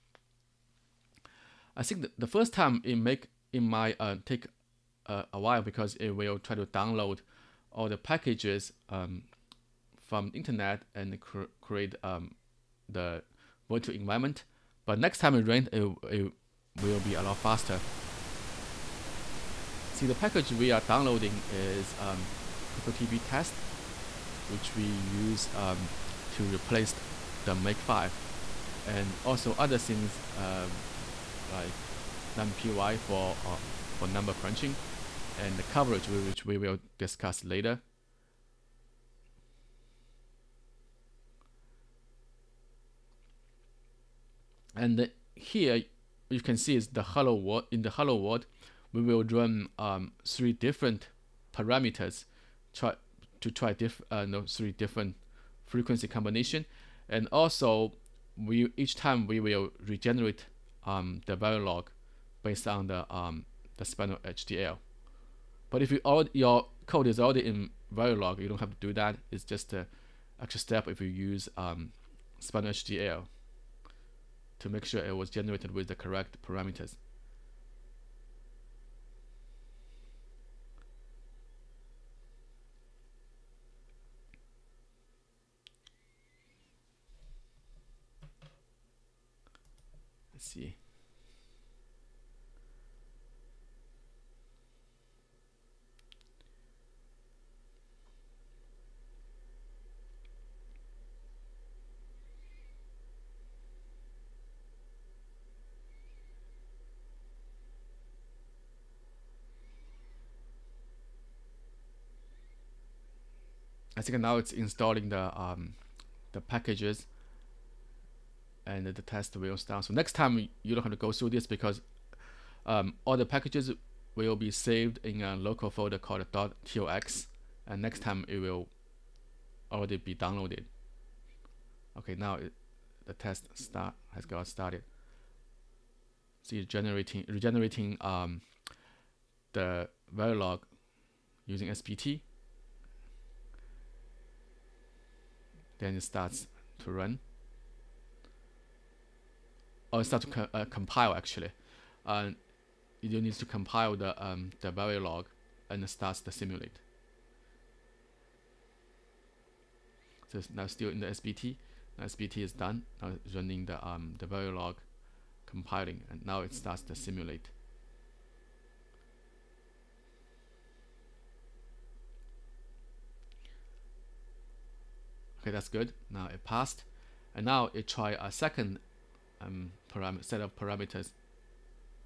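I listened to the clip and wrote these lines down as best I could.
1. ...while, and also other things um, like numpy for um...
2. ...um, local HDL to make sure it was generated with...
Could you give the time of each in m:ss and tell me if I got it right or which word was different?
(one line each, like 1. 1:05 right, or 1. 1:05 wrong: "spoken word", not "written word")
1. 0:27 wrong: "makefile", not "while"
2. 1:11 wrong: "spinal", not "local".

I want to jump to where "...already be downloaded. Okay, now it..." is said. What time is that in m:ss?
2:09.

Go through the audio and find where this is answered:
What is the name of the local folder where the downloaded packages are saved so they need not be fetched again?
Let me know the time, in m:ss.
2:06.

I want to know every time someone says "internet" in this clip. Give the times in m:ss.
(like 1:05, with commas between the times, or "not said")
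0:10.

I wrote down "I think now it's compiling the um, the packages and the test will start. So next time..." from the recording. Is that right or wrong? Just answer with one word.
wrong.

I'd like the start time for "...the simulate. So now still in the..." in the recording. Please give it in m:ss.
2:36.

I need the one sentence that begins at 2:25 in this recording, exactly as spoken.
Then it starts to run or oh, start to co uh, compile actually.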